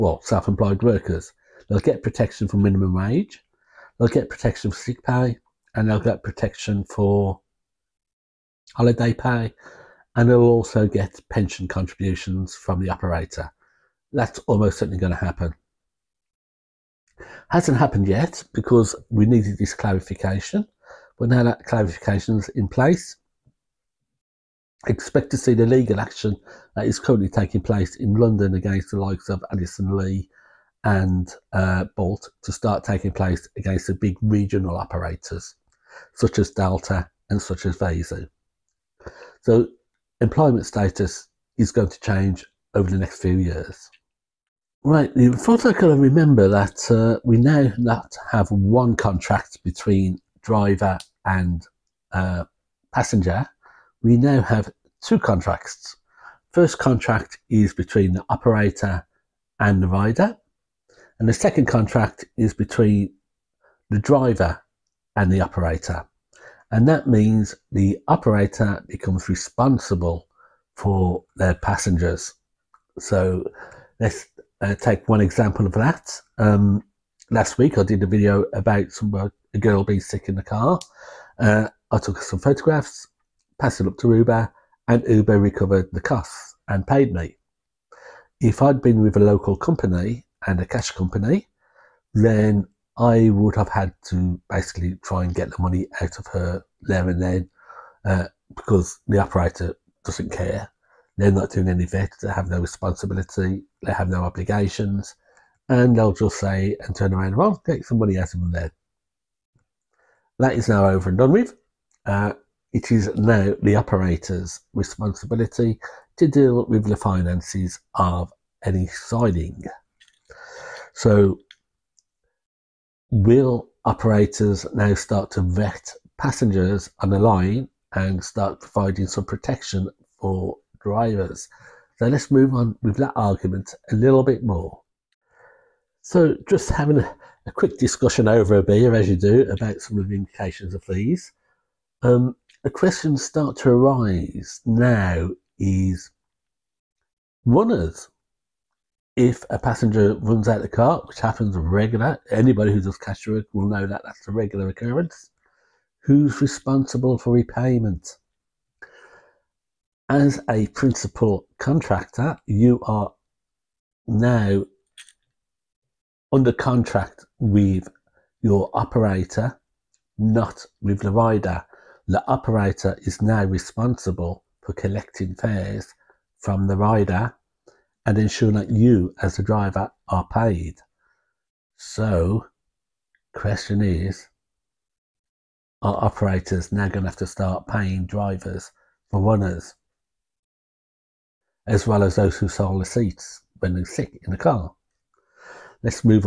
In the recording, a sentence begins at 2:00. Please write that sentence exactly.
So will operators now start to vet passengers on the line and start providing some protection for drivers?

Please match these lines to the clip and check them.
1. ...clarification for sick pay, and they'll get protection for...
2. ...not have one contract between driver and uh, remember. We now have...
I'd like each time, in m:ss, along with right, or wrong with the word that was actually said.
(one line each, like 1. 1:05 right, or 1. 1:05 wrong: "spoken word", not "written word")
1. 0:04 wrong: "protection", not "clarification"
2. 0:47 wrong: "passenger", not "remember".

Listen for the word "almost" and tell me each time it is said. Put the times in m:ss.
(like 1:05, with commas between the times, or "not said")
0:14.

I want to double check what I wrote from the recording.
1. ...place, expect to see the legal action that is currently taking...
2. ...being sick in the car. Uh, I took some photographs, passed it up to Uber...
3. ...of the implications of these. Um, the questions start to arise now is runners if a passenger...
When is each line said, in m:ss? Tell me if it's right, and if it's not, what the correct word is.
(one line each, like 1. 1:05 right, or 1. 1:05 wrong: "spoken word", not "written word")
1. 0:22 right
2. 1:19 right
3. 2:19 right.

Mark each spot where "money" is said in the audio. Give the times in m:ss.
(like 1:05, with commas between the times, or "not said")
1:35, 1:47.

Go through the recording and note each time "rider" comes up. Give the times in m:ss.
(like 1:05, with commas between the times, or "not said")
0:59, 2:51, 2:56.